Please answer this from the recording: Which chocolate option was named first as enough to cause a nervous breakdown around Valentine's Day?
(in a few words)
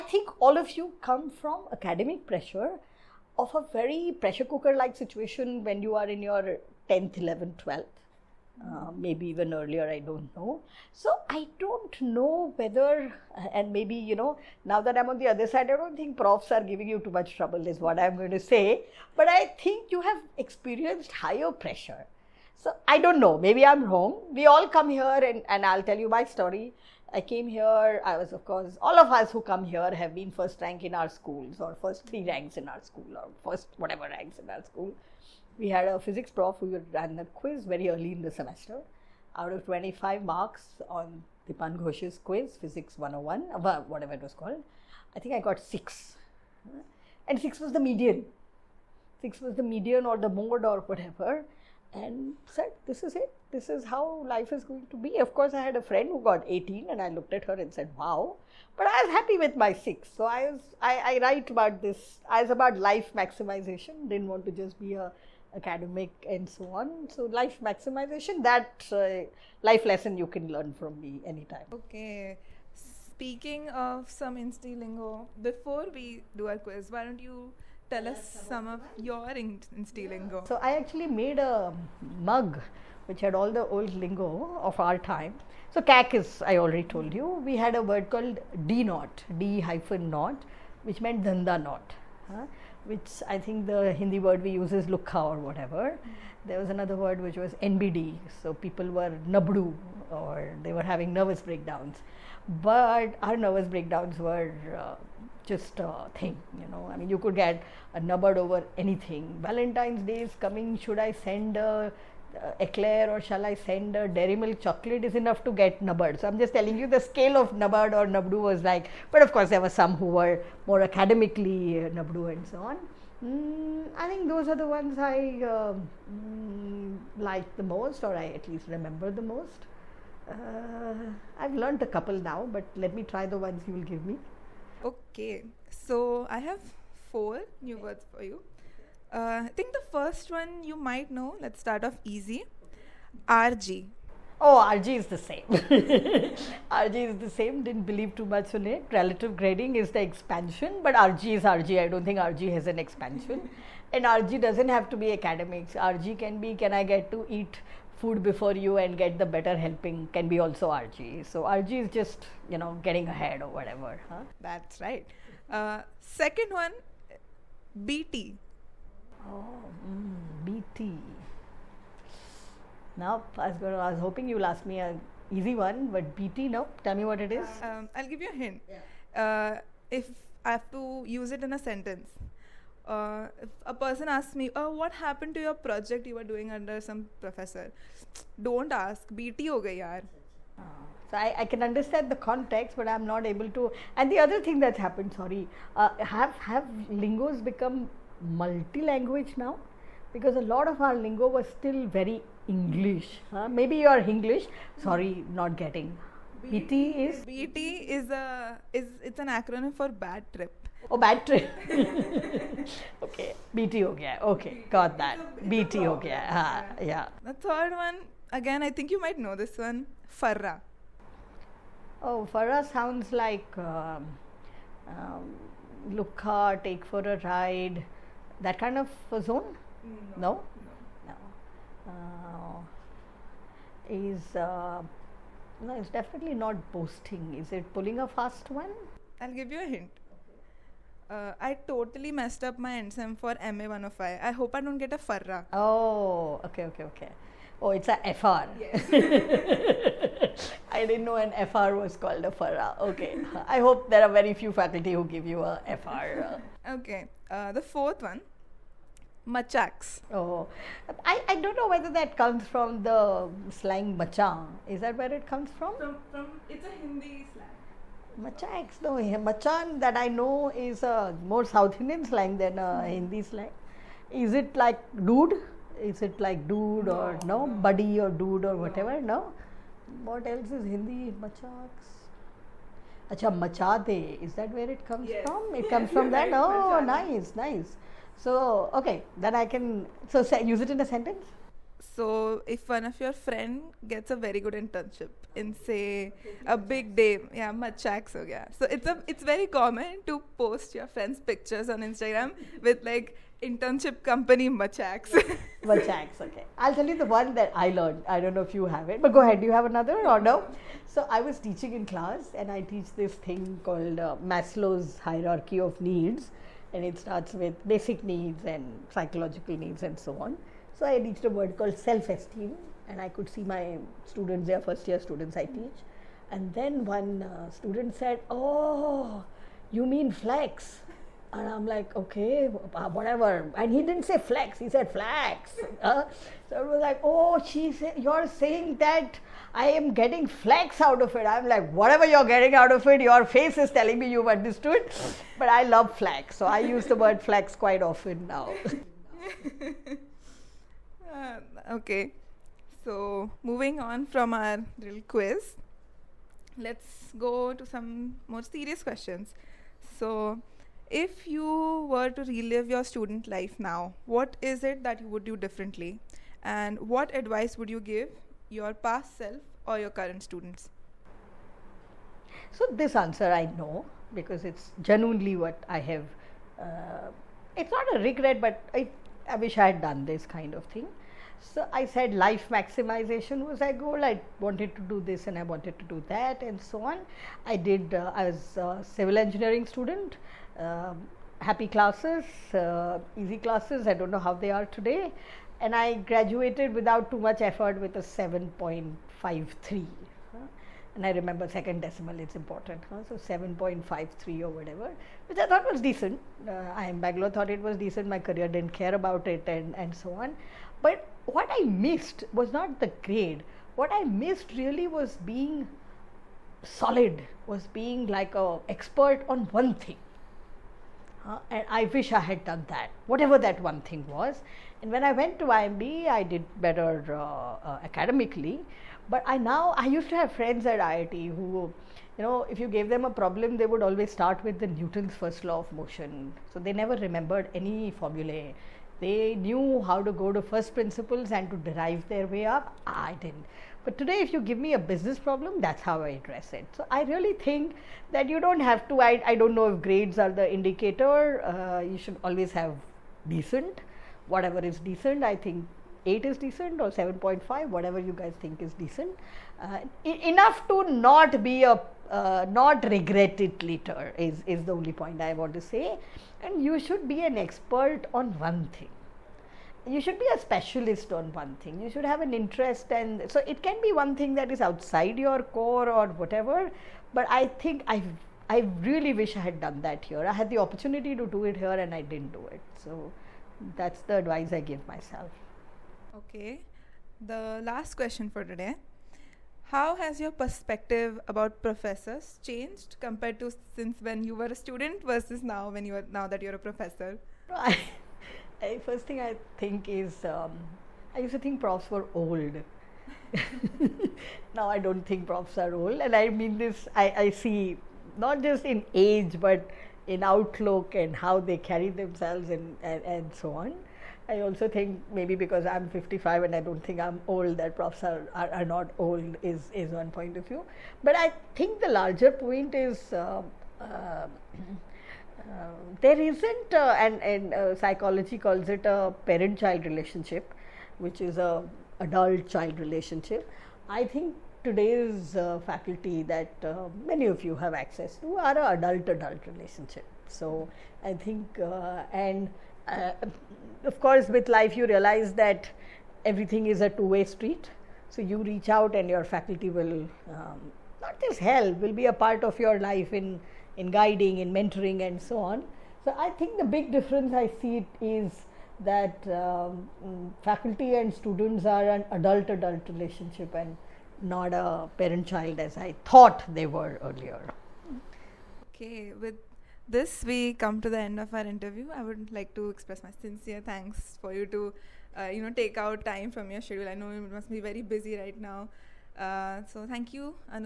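eclair.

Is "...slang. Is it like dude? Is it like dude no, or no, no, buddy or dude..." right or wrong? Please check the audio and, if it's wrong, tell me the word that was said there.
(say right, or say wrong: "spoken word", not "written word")
right.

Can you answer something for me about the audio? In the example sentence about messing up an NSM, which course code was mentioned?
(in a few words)
MA 105.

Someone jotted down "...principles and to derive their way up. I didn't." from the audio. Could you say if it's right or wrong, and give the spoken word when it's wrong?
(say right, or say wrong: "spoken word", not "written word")
right.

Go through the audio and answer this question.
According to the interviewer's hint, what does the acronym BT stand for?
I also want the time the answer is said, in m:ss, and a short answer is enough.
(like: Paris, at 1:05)
bad trip, at 3:30.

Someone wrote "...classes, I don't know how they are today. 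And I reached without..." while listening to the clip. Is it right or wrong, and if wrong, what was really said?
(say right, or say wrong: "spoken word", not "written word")
wrong: "graduated", not "reached".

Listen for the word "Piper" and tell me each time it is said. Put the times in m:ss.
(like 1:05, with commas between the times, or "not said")
not said.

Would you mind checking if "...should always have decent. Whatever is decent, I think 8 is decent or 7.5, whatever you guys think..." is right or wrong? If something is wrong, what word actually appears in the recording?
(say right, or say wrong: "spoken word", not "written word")
right.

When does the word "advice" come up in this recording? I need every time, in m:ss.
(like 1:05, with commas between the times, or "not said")
6:07, 8:04.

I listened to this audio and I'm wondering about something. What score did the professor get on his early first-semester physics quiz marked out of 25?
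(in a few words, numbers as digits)
6.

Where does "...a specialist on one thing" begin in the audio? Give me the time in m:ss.
7:50.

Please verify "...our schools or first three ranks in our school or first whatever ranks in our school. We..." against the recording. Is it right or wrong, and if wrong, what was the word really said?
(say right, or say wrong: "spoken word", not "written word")
right.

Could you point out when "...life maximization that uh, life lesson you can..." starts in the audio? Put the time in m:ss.
1:07.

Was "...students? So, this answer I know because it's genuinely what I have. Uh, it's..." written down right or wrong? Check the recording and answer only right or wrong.
right.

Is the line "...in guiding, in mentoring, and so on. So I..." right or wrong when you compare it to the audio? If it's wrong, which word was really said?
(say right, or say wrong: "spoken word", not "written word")
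right.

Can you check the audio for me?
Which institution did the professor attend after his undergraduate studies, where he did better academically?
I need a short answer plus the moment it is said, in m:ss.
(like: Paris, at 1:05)
IIMB, at 7:05.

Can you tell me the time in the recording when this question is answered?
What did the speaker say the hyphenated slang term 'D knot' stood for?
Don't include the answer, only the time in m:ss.
1:31.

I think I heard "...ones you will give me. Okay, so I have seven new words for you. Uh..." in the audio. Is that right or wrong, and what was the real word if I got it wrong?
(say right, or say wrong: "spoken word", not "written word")
wrong: "four", not "seven".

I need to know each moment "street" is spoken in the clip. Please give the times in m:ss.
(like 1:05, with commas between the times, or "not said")
9:07.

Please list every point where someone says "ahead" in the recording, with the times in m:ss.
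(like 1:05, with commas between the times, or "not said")
2:43, 5:09.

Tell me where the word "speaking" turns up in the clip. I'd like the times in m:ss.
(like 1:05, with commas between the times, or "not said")
1:12.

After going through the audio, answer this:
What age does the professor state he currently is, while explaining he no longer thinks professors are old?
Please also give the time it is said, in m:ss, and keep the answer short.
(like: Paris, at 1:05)
55, at 8:35.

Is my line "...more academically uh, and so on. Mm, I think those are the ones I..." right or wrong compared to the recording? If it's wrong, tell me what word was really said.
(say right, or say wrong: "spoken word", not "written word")
right.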